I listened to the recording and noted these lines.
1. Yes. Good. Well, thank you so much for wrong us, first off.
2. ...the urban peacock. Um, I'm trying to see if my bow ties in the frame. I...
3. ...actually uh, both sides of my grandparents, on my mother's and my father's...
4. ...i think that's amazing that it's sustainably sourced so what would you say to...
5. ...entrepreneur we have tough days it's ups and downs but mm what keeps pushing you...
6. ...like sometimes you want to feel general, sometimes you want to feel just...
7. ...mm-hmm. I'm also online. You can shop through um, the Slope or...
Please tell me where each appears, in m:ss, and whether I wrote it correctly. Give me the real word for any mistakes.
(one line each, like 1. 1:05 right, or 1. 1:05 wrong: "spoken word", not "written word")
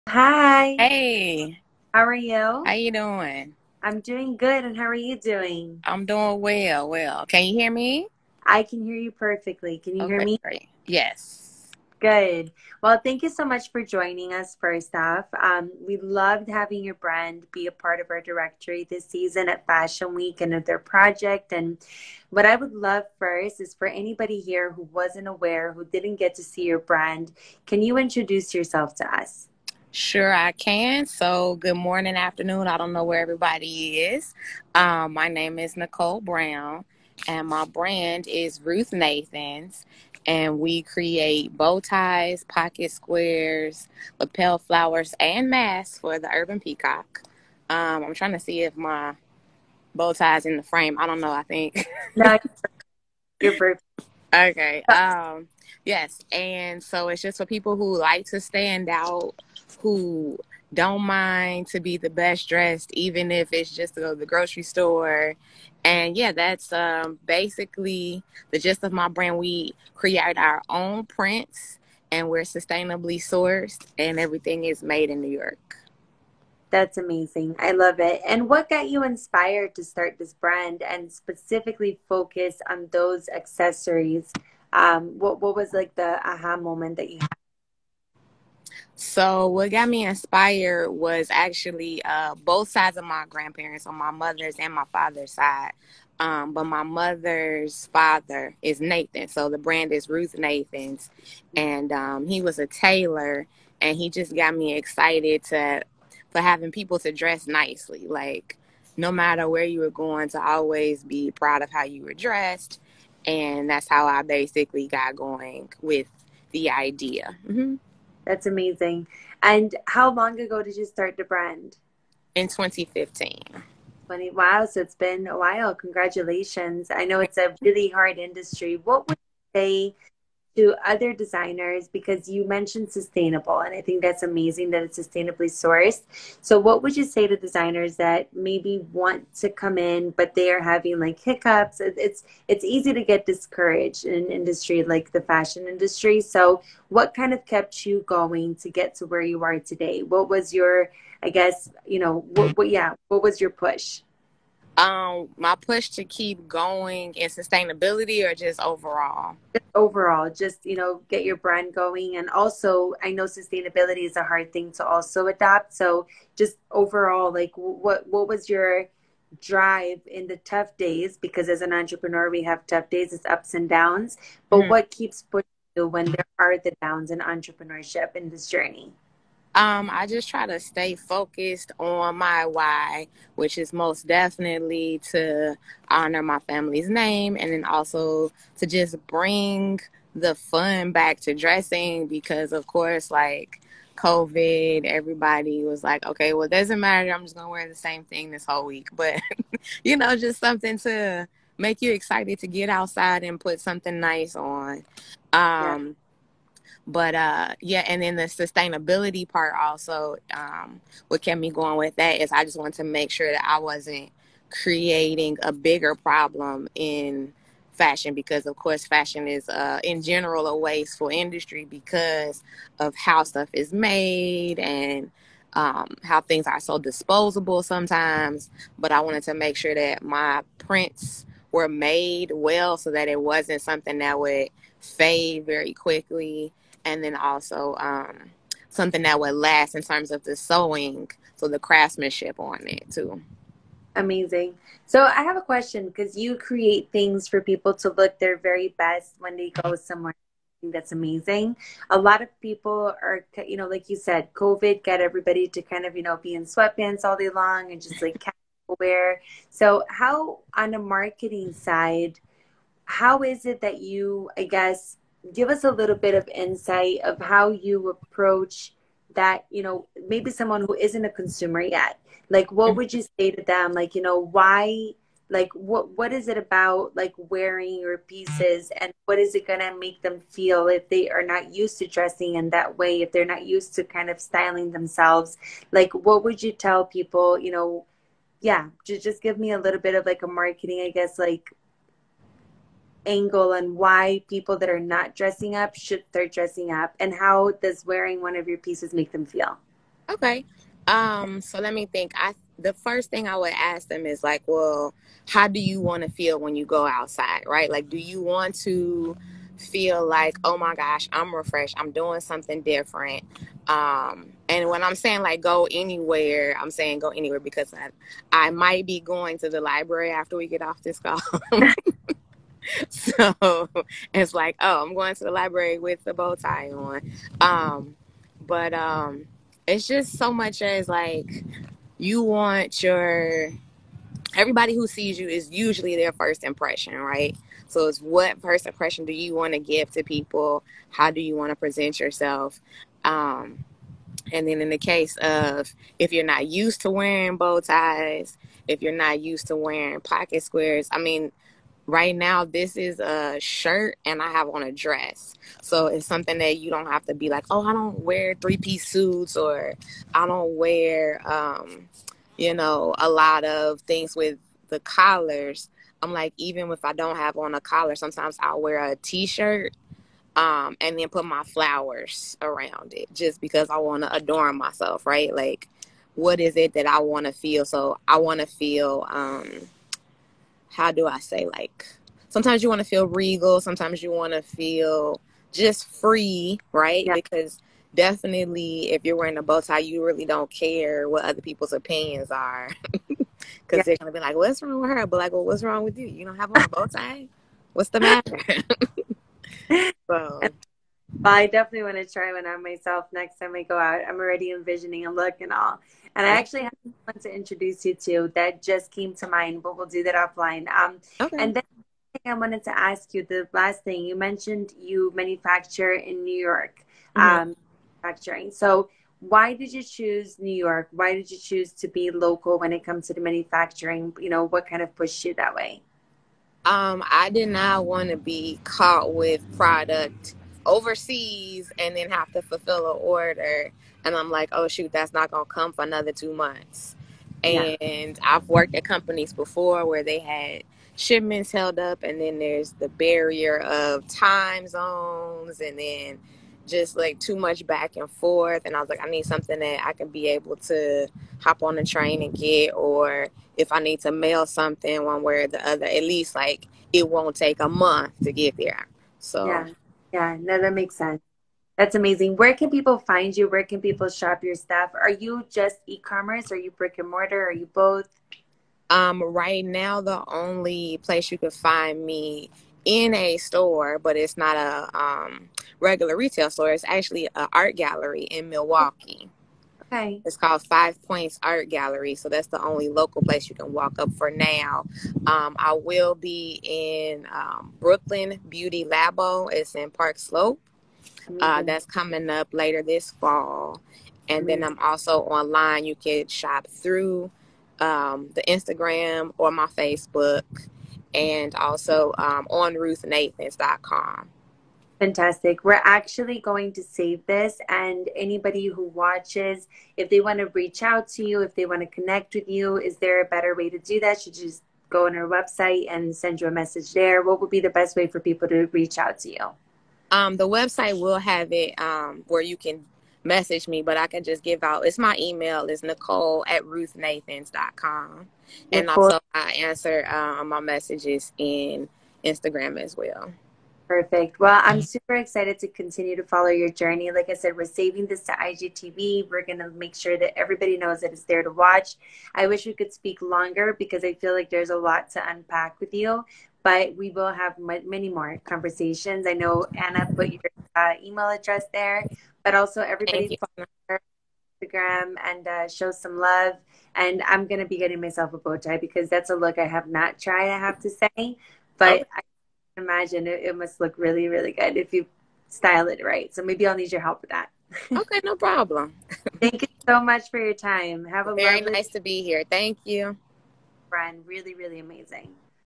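1. 0:10 wrong: "joining", not "wrong"
2. 0:46 right
3. 1:31 right
4. 2:13 right
5. 2:51 right
6. 6:21 wrong: "regal", not "general"
7. 8:14 wrong: "Instagram", not "Slope".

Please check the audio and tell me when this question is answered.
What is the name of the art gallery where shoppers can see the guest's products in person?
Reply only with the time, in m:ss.
8:00.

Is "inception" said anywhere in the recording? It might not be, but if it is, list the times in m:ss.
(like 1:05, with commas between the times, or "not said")
not said.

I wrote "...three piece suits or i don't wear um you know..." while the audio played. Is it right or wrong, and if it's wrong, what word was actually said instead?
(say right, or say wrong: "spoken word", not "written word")
right.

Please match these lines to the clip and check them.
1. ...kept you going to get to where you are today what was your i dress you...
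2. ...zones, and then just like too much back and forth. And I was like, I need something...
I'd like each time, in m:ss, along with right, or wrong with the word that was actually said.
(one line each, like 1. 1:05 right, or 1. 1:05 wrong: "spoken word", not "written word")
1. 2:27 wrong: "guess", not "dress"
2. 7:24 right.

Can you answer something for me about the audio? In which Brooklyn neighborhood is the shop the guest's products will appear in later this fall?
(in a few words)
Park Slope.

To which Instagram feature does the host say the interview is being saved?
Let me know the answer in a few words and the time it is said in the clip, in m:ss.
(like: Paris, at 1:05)
IGTV, at 8:58.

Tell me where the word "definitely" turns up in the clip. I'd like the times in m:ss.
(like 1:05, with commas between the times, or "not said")
3:04, 6:27, 6:41.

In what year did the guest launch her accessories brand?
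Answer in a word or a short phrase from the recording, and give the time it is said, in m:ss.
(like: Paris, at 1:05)
2015, at 2:02.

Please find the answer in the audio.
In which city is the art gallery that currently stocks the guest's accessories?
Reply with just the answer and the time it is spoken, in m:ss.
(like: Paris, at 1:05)
Milwaukee, at 7:58.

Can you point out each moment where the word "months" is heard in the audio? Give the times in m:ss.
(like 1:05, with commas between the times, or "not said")
7:16, 7:37.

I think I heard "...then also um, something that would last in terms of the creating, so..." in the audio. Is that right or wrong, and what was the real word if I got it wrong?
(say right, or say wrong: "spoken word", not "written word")
wrong: "sewing", not "creating".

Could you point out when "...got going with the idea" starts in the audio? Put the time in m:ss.
1:54.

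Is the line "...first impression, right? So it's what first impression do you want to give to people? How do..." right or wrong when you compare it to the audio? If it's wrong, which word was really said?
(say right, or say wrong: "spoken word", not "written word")
right.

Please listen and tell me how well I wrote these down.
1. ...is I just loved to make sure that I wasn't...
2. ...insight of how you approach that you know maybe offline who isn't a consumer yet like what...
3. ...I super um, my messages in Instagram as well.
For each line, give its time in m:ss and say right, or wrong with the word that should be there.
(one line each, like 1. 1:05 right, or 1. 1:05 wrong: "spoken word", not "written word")
1. 3:32 wrong: "wanted", not "loved"
2. 4:26 wrong: "someone", not "offline"
3. 8:49 wrong: "answer", not "super".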